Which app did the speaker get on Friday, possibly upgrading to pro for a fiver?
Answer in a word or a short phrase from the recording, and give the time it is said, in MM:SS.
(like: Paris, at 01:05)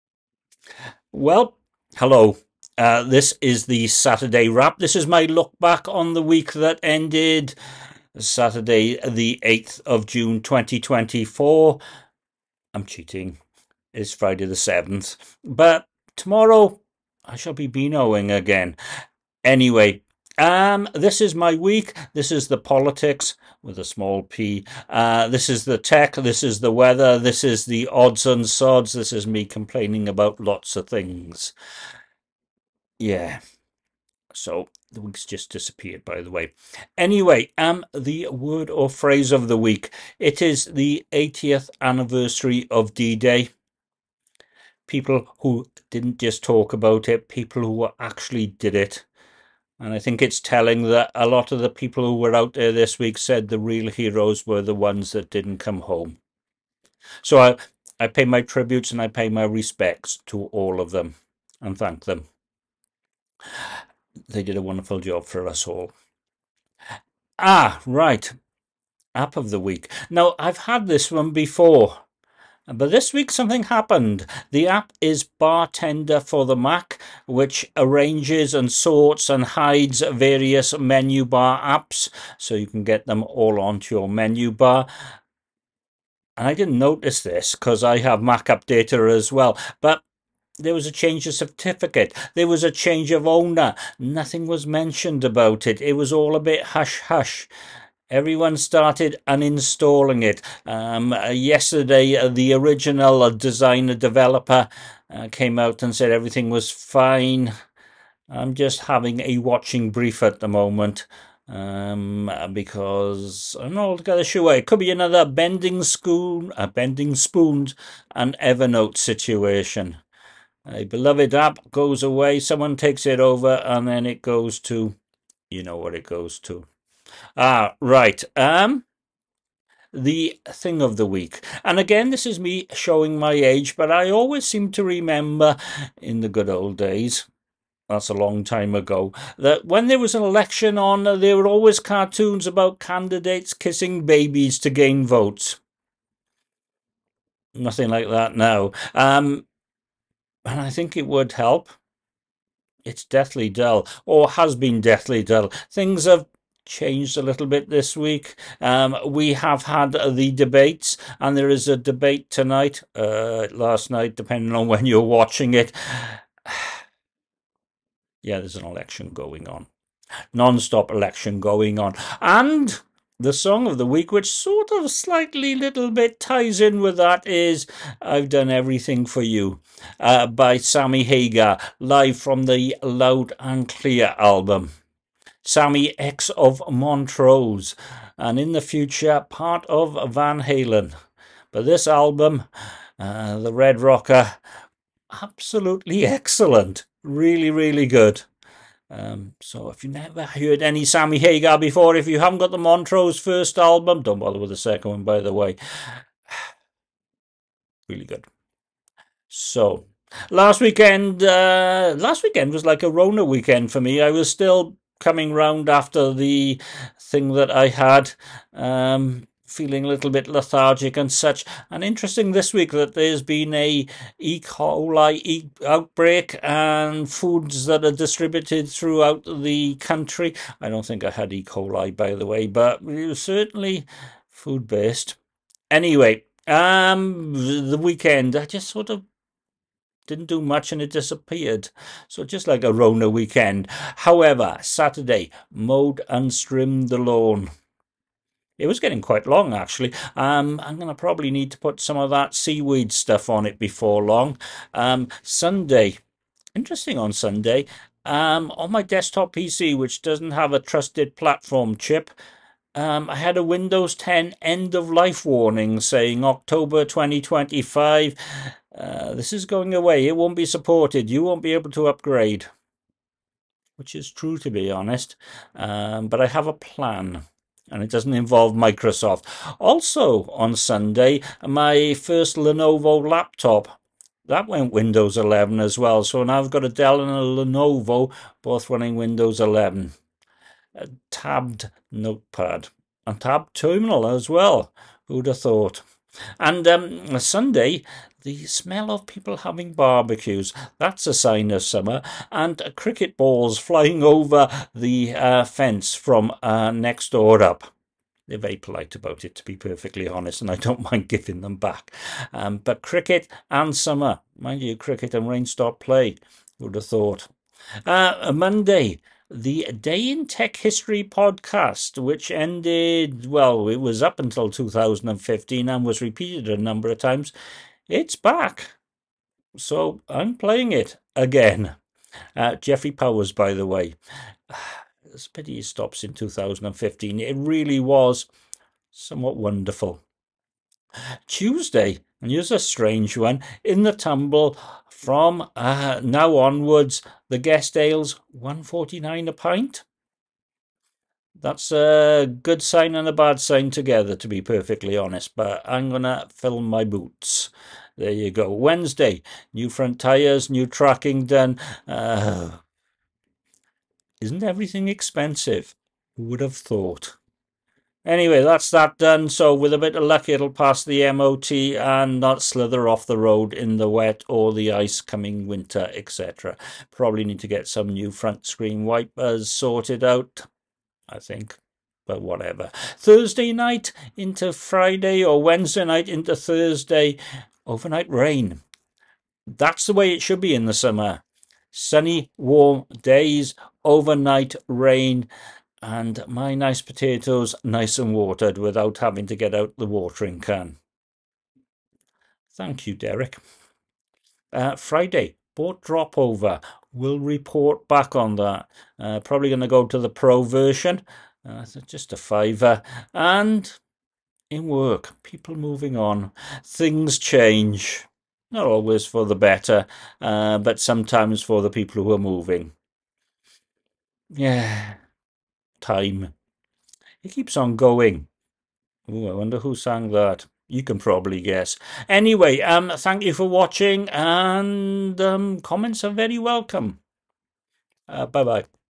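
Dropover, at 06:45.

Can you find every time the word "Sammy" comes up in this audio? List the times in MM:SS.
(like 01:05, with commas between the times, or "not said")
03:00, 03:05, 03:20.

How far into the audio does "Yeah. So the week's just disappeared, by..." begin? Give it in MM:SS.
00:32.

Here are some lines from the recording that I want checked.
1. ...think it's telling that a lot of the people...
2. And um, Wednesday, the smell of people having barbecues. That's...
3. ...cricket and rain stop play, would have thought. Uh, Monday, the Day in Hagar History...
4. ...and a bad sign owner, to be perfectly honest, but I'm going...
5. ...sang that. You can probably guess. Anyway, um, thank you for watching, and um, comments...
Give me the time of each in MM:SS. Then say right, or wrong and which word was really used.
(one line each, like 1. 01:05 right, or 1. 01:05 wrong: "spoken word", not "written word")
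1. 00:49 right
2. 04:56 wrong: "Sunday", not "Wednesday"
3. 05:14 wrong: "Tech", not "Hagar"
4. 05:52 wrong: "together", not "owner"
5. 07:09 right.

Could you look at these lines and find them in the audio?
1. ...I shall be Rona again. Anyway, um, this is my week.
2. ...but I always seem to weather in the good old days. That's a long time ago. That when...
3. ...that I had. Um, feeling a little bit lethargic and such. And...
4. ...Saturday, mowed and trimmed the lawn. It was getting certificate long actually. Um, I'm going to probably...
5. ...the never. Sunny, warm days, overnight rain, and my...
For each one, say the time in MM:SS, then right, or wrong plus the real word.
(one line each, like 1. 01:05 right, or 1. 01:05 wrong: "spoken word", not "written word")
1. 00:17 wrong: "Beanoing", not "Rona"
2. 02:13 wrong: "remember", not "weather"
3. 03:37 right
4. 04:04 wrong: "quite", not "certificate"
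5. 06:30 wrong: "summer", not "never".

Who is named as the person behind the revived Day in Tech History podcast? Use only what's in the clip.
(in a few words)
Jeffrey Powers.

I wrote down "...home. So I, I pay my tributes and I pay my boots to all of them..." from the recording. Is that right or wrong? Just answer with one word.
wrong.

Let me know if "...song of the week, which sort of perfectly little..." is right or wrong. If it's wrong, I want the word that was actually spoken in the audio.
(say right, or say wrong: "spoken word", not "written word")
wrong: "slightly", not "perfectly".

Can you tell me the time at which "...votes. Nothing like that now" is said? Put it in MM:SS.
02:25.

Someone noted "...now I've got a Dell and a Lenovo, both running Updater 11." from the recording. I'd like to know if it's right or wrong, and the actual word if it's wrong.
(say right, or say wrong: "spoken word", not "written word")
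wrong: "Windows", not "Updater".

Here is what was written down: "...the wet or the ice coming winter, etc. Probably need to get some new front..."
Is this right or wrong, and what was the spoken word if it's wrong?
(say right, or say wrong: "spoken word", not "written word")
right.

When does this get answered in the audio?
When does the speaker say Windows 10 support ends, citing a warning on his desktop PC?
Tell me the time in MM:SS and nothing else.
04:26.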